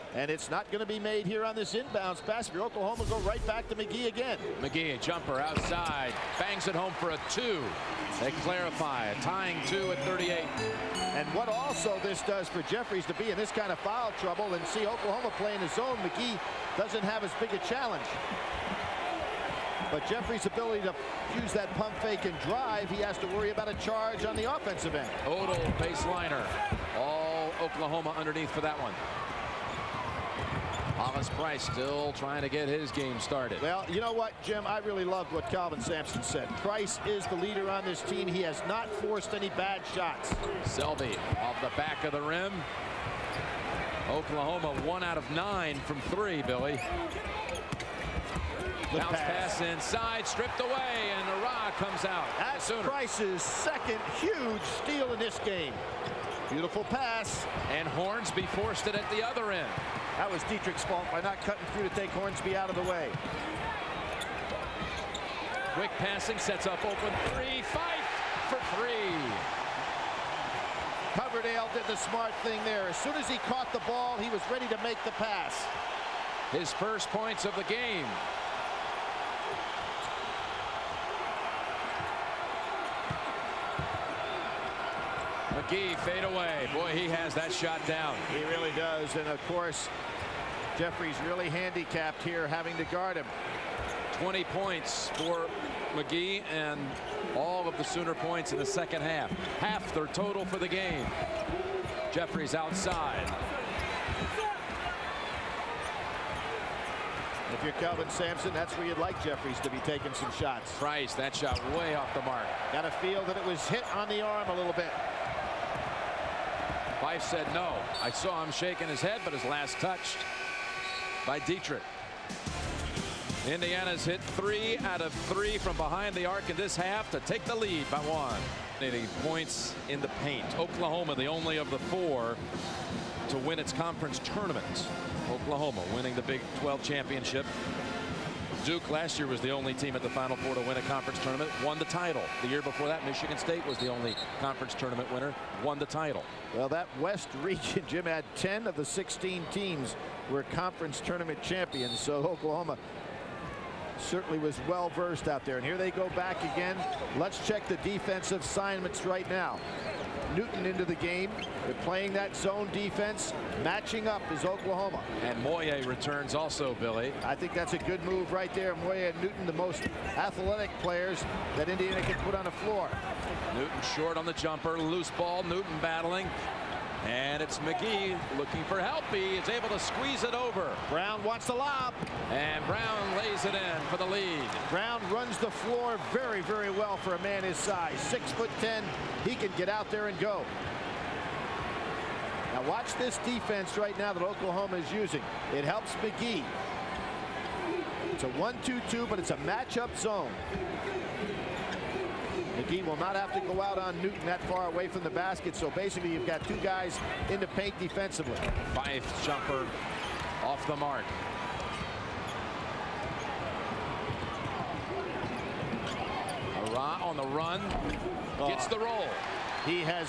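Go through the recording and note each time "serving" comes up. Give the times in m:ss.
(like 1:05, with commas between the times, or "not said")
not said.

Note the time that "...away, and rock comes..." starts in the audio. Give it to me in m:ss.
0:50.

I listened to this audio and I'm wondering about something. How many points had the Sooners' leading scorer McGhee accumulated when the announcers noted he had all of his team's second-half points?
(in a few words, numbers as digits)
20.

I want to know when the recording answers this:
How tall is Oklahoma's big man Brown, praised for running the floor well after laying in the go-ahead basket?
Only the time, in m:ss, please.
3:07.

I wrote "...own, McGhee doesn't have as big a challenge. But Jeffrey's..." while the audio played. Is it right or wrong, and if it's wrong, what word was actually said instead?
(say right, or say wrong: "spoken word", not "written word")
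right.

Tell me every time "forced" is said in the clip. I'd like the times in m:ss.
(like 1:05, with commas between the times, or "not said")
0:38, 0:58.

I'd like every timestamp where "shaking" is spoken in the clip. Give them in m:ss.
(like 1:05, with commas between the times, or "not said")
1:58.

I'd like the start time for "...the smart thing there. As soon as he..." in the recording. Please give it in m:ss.
1:11.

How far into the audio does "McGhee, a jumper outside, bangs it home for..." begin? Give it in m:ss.
0:04.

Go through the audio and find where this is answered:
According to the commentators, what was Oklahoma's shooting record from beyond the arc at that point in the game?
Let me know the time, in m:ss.
0:44.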